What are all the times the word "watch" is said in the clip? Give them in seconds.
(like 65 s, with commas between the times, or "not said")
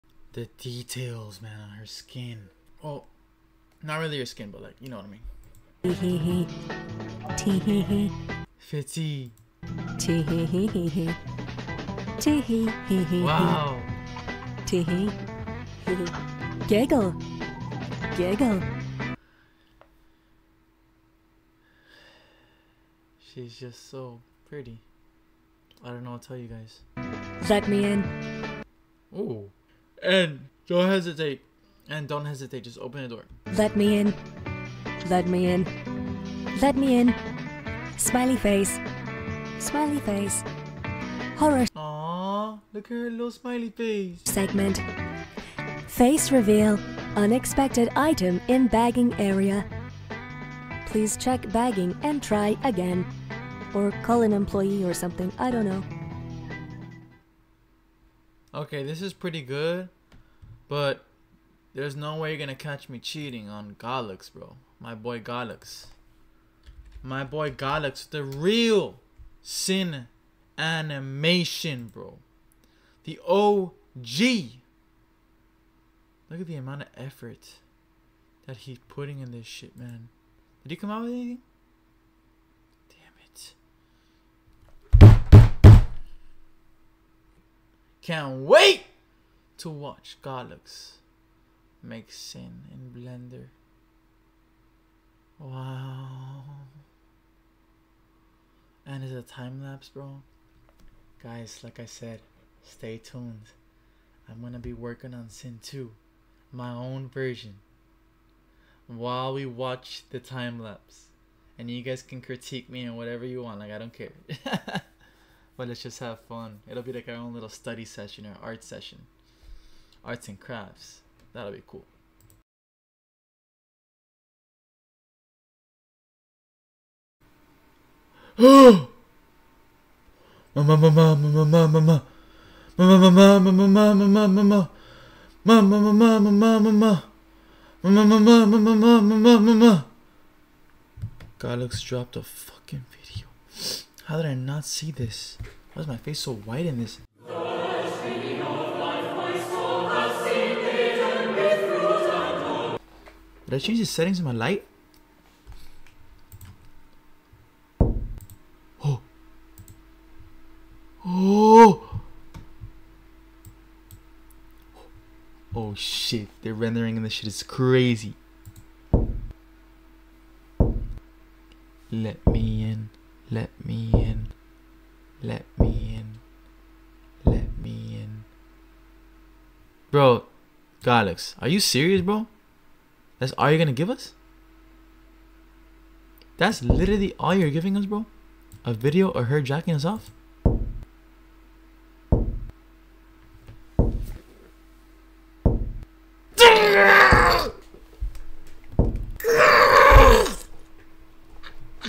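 89 s, 109 s.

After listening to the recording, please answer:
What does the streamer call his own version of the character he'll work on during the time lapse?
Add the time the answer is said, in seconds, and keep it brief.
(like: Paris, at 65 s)
Cyn 2, at 105 s.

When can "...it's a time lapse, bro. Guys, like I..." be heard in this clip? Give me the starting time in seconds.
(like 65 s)
99 s.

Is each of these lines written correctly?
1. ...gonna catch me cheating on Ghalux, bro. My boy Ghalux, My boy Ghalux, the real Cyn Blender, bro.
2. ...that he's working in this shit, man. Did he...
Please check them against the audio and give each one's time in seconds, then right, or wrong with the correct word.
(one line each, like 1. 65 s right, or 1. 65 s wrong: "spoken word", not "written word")
1. 62 s wrong: "Animation", not "Blender"
2. 78 s wrong: "putting", not "working".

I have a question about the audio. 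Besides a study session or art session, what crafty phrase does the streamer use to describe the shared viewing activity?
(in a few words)
Arts and crafts.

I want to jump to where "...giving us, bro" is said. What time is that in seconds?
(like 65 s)
187 s.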